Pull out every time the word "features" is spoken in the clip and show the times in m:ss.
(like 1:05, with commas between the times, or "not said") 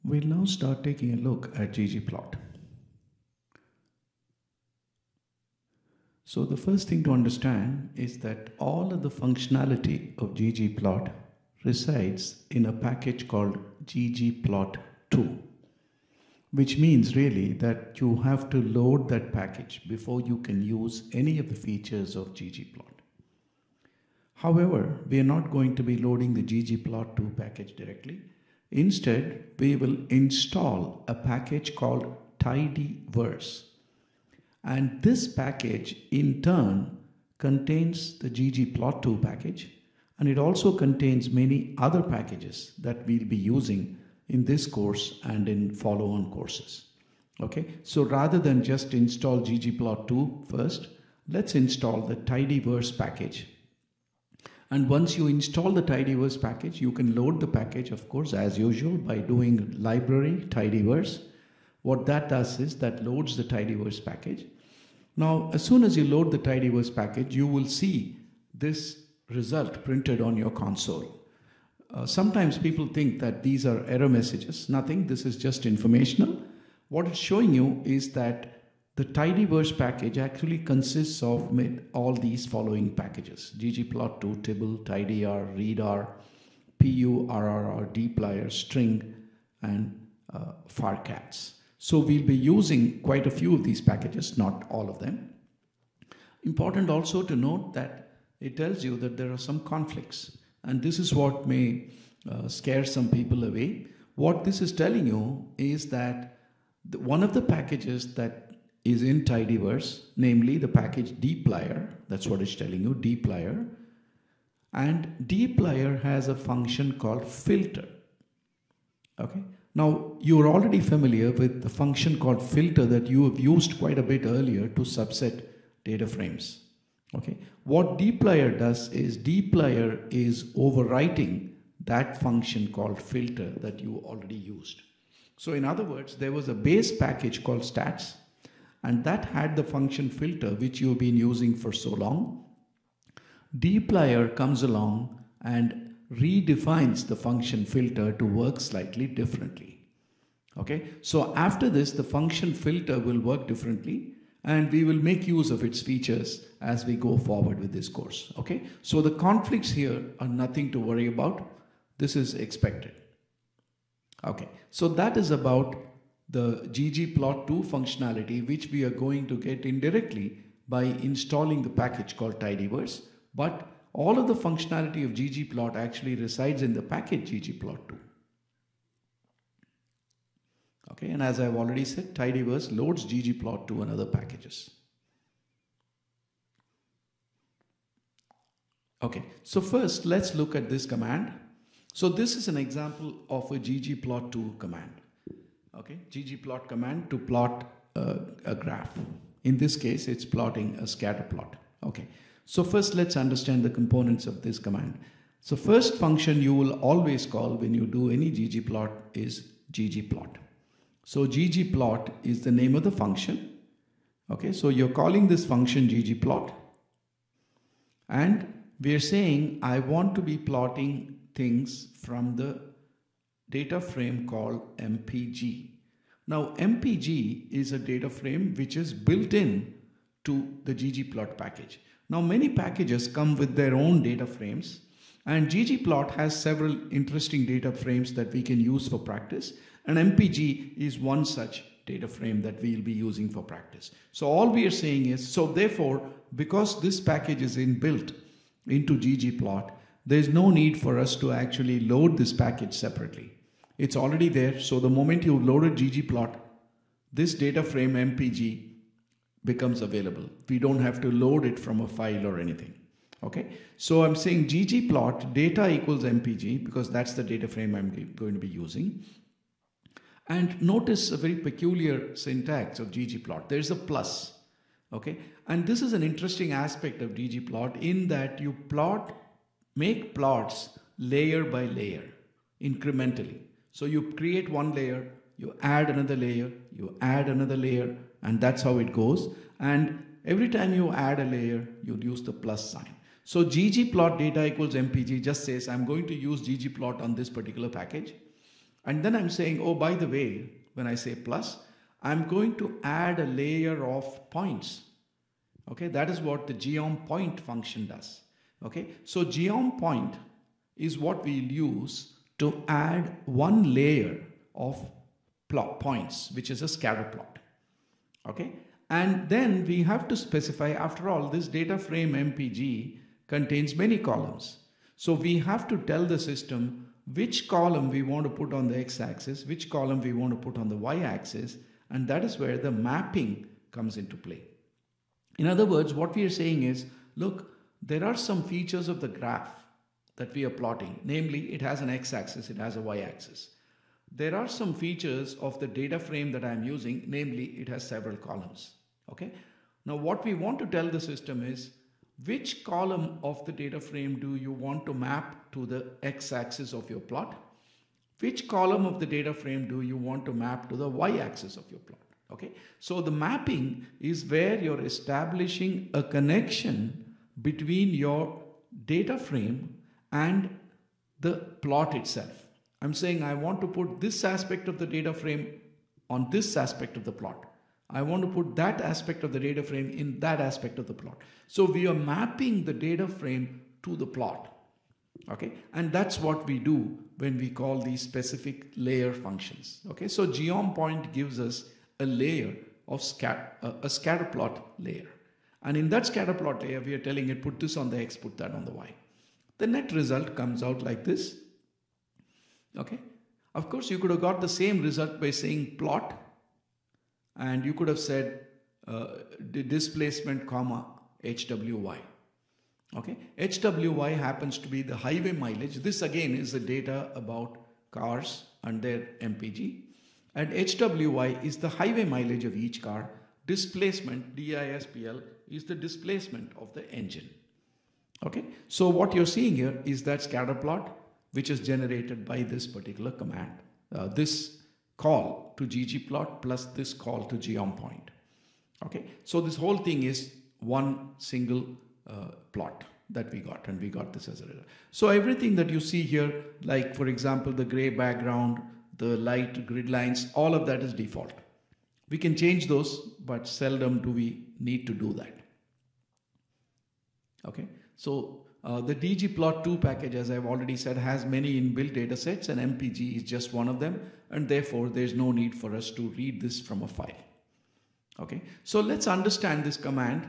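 0:21, 2:35, 5:38, 5:44.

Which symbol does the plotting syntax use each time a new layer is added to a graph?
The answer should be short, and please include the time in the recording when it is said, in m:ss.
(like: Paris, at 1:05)
plus sign, at 4:51.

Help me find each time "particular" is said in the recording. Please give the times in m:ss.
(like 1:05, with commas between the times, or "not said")
4:57, 7:12.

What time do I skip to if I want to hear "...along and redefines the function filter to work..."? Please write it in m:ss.
2:24.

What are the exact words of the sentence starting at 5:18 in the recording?
Okay, and then we have to specify, after all, this data frame MPG contains many columns.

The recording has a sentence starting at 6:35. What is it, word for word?
And in that scatter plot layer, we are telling it put this on the x, put that on the y.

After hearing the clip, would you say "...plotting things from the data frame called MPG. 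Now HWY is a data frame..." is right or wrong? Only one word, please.
wrong.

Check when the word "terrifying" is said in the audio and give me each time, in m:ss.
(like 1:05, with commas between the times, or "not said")
not said.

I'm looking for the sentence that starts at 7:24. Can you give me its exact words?
So everything that you see here, like for example, the gray background, the light grid lines, all of that is default.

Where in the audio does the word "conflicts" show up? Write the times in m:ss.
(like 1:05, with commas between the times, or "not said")
1:39, 2:39.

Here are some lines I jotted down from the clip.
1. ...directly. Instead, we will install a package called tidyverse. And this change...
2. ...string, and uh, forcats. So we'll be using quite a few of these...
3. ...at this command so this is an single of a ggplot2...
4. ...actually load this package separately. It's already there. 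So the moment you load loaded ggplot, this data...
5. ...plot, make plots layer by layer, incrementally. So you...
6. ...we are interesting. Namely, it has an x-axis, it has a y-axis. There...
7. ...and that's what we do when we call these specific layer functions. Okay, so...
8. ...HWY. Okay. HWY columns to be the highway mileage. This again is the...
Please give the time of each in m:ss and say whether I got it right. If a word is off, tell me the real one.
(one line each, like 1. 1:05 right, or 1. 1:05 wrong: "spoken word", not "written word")
1. 0:27 wrong: "package", not "change"
2. 1:28 right
3. 3:10 wrong: "example", not "single"
4. 4:11 right
5. 4:38 right
6. 5:40 wrong: "plotting", not "interesting"
7. 6:25 right
8. 6:51 wrong: "happens", not "columns".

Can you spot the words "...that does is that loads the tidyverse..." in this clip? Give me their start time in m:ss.
1:02.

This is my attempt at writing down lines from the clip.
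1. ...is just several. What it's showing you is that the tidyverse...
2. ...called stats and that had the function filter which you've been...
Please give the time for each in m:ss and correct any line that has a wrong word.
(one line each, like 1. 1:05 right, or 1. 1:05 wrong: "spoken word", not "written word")
1. 1:15 wrong: "informational", not "several"
2. 2:17 right.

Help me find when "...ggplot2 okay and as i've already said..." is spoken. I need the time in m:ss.
2:57.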